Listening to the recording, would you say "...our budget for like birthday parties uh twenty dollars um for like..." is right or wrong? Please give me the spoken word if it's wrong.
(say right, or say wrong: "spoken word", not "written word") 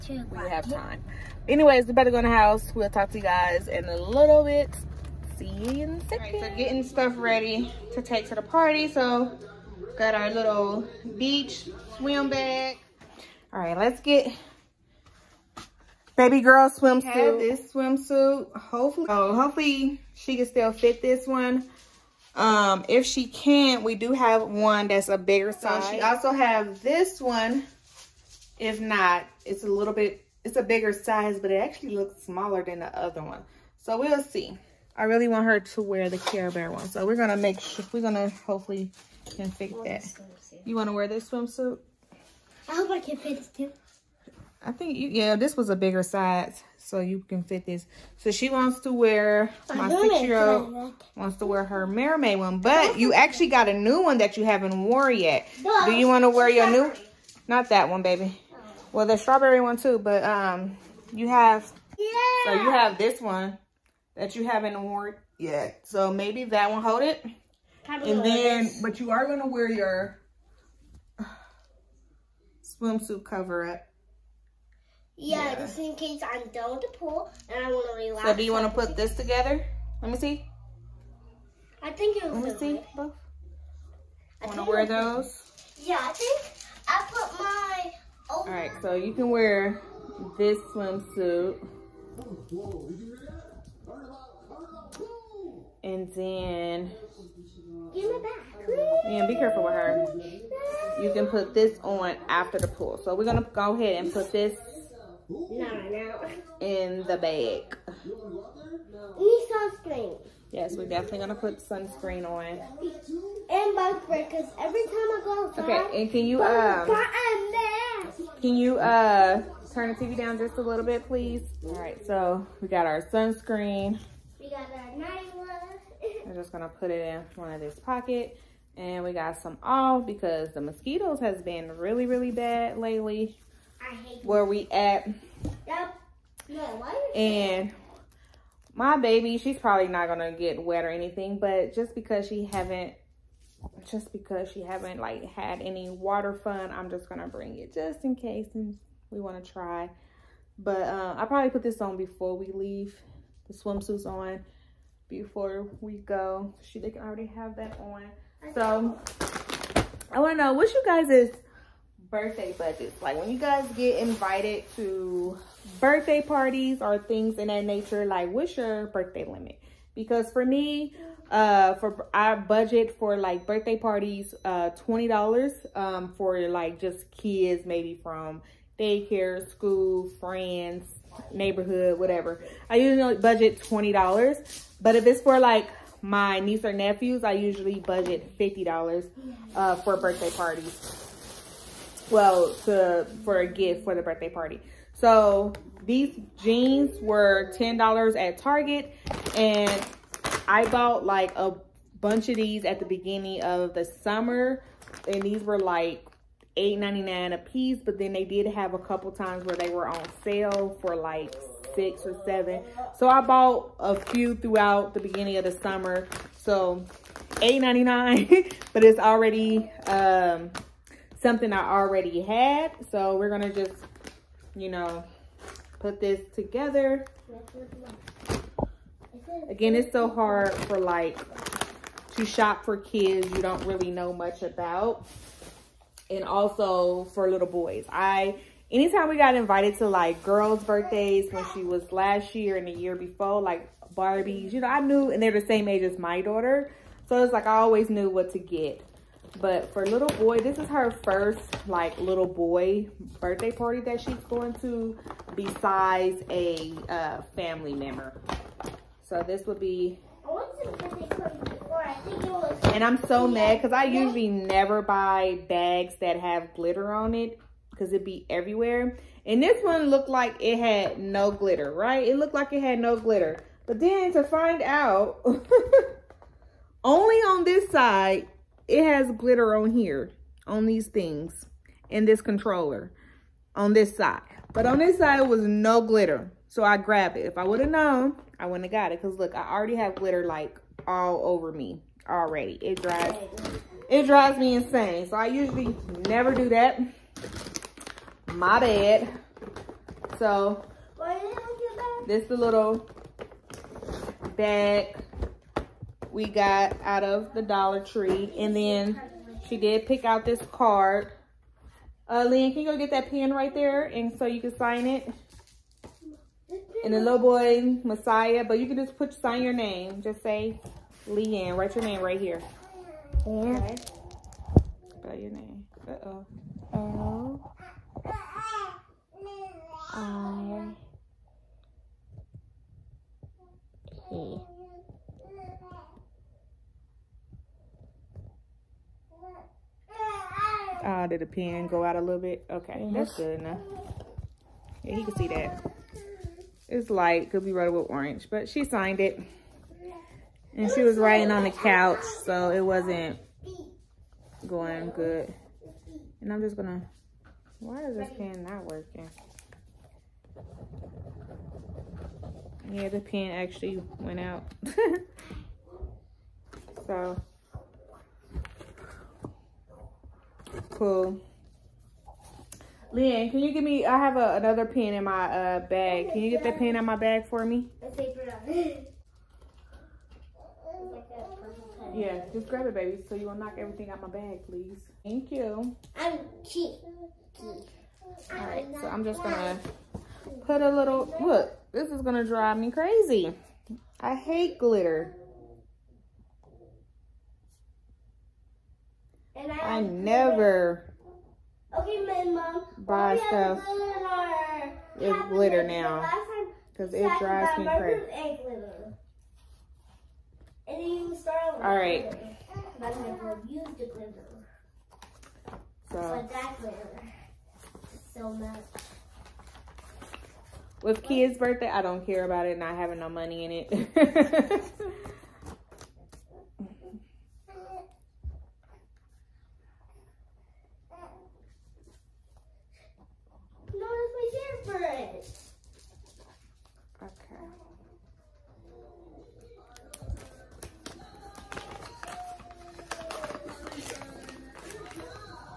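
right.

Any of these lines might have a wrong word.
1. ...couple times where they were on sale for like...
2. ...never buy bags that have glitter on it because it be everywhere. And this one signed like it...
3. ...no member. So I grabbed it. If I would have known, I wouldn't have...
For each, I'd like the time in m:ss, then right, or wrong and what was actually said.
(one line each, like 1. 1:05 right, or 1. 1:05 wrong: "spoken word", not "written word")
1. 3:28 right
2. 4:24 wrong: "looked", not "signed"
3. 4:45 wrong: "glitter", not "member".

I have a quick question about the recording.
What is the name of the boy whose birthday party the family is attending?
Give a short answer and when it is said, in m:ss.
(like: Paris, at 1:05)
Messiah, at 5:17.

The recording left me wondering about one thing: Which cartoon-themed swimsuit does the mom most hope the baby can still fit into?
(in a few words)
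Care Bear.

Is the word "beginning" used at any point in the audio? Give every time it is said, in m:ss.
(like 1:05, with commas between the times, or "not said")
3:22, 3:34.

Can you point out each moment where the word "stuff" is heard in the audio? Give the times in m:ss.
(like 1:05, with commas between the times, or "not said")
0:06, 6:43.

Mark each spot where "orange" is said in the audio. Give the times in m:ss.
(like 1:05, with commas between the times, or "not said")
5:47.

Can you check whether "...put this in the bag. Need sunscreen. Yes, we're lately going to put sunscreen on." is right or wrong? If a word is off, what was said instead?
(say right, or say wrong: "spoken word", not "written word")
wrong: "definitely", not "lately".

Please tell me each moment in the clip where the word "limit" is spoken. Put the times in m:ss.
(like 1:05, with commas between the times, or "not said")
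2:49.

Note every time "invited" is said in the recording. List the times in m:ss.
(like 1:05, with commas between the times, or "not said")
2:43, 3:59.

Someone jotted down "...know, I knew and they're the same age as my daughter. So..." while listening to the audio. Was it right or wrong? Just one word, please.
right.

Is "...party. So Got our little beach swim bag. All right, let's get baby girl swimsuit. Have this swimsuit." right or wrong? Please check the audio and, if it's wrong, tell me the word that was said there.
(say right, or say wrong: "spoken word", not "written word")
right.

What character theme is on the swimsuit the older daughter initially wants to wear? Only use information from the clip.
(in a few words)
Mermaid.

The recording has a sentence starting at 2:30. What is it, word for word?
But uh, I probably put this on before we leave, the swimsuits on before we go.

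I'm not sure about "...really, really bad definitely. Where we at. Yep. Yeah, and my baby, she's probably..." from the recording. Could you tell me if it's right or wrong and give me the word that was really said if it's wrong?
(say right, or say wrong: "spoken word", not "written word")
wrong: "lately", not "definitely".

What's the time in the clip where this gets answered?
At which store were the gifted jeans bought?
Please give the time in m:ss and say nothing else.
3:18.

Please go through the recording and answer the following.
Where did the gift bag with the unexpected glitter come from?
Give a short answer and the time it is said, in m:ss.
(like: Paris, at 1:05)
Dollar Tree, at 5:07.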